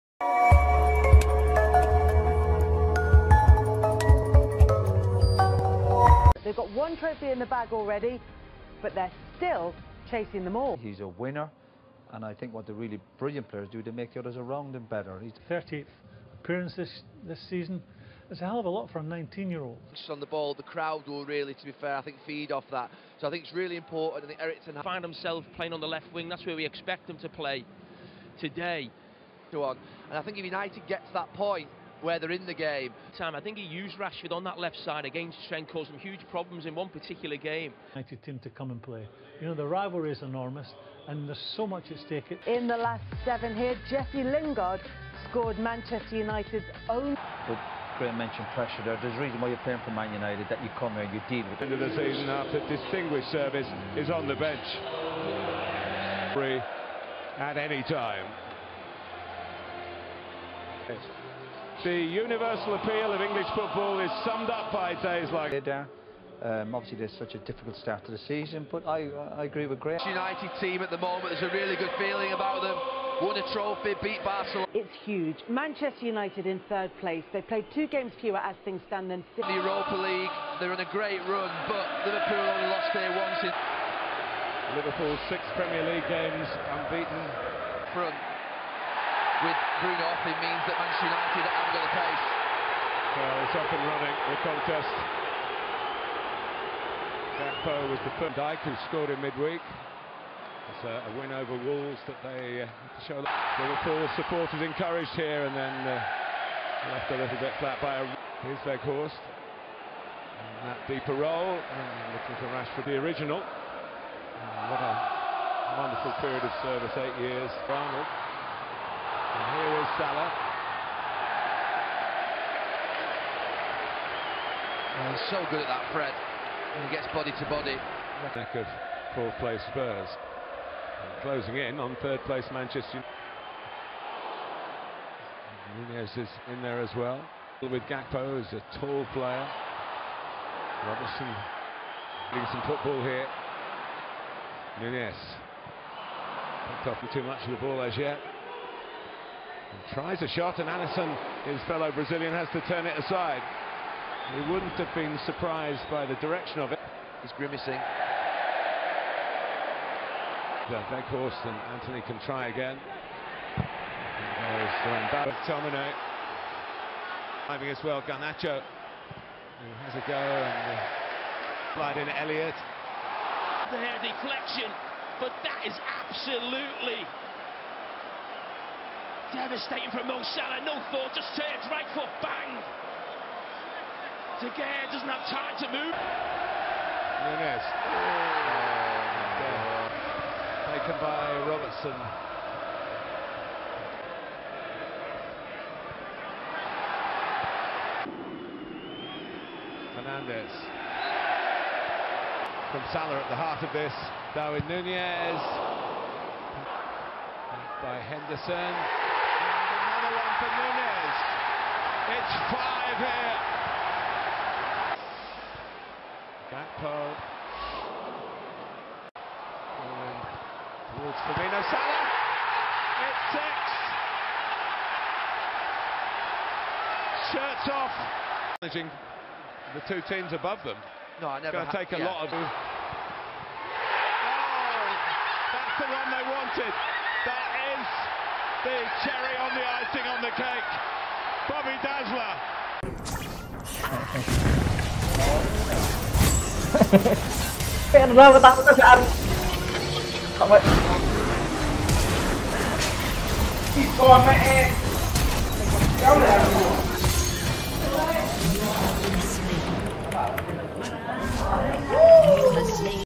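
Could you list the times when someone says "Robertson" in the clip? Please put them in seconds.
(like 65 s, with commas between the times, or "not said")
140 s, 191 s.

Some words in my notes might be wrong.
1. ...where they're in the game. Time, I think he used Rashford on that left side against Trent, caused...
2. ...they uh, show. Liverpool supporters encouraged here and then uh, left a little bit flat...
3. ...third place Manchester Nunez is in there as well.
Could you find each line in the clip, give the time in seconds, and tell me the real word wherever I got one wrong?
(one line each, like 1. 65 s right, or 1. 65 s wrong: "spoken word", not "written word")
1. 32 s right
2. 102 s right
3. 132 s right.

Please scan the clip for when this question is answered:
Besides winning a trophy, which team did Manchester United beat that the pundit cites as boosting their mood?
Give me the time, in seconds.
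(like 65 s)
74 s.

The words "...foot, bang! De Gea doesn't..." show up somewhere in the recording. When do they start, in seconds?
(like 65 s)
181 s.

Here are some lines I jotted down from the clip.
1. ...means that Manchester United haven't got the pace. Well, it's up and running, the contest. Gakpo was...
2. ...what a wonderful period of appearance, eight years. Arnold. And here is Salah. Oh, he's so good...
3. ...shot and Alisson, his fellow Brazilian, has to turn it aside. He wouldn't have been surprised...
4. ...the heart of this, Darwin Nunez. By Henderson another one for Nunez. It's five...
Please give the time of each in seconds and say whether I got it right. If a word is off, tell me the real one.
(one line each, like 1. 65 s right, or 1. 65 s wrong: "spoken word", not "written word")
1. 90 s right
2. 114 s wrong: "service", not "appearance"
3. 150 s right
4. 203 s right.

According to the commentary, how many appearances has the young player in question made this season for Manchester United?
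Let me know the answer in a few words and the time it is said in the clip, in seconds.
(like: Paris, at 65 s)
38, at 15 s.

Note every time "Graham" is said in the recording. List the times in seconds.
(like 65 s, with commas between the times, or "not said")
47 s, 69 s.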